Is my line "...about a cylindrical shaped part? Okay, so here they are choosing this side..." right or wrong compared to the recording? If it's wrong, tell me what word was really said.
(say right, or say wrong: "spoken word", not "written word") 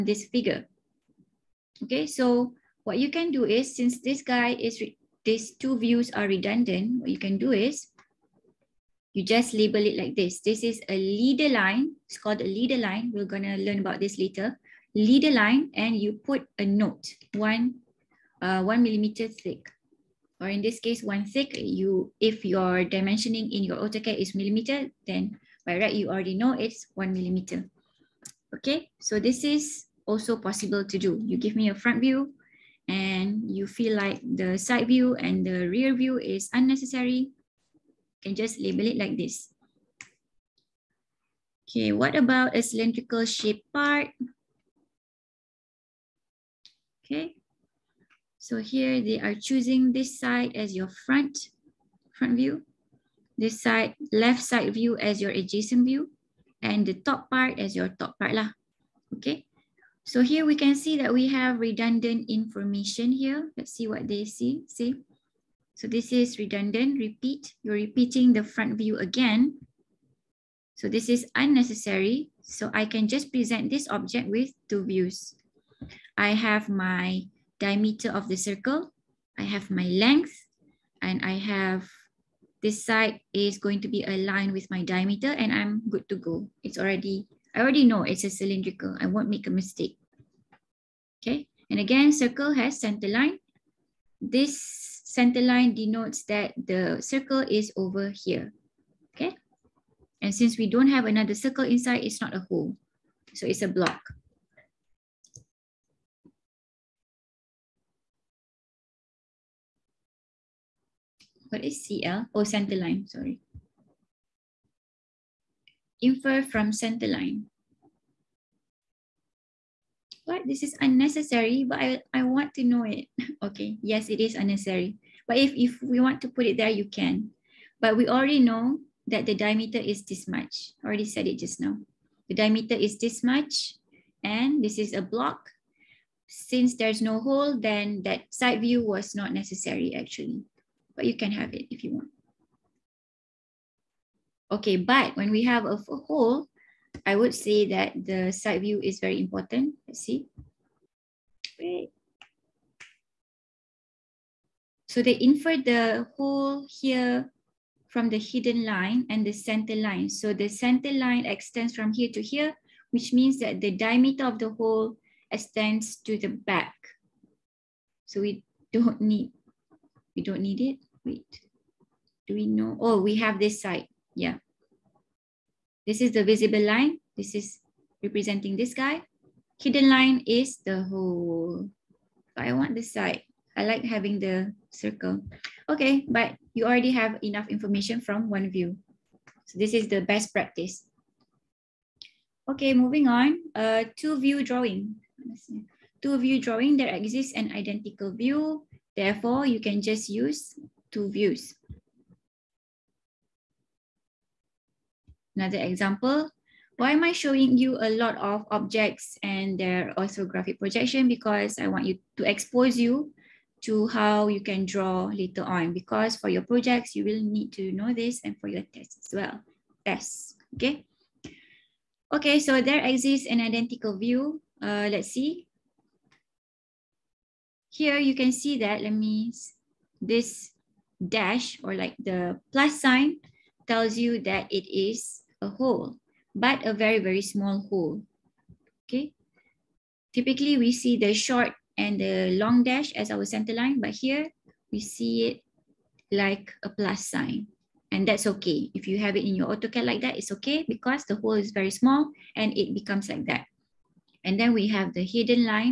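right.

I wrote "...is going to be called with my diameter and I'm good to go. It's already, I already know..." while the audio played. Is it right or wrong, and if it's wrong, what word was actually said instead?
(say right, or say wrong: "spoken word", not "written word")
wrong: "aligned", not "called".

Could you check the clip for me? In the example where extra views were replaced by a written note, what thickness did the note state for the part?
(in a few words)
1 millimeter.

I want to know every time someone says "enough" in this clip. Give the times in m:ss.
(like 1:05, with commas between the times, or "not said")
3:07.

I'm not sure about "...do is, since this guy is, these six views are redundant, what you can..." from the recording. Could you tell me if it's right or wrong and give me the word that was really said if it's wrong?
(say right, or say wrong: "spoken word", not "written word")
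wrong: "two", not "six".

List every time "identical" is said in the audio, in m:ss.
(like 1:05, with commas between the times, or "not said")
3:17, 3:43.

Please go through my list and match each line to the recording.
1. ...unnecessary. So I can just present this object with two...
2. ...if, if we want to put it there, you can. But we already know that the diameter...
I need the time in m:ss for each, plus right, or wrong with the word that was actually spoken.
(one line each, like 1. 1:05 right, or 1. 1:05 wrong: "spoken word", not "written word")
1. 1:11 right
2. 2:05 right.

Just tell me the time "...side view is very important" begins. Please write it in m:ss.
2:28.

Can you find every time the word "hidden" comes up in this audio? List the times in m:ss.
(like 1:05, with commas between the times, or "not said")
2:38, 2:59, 4:15.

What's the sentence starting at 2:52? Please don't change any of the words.
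Oh, we have this side, yeah.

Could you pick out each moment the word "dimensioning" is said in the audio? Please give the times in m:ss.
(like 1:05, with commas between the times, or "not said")
0:22.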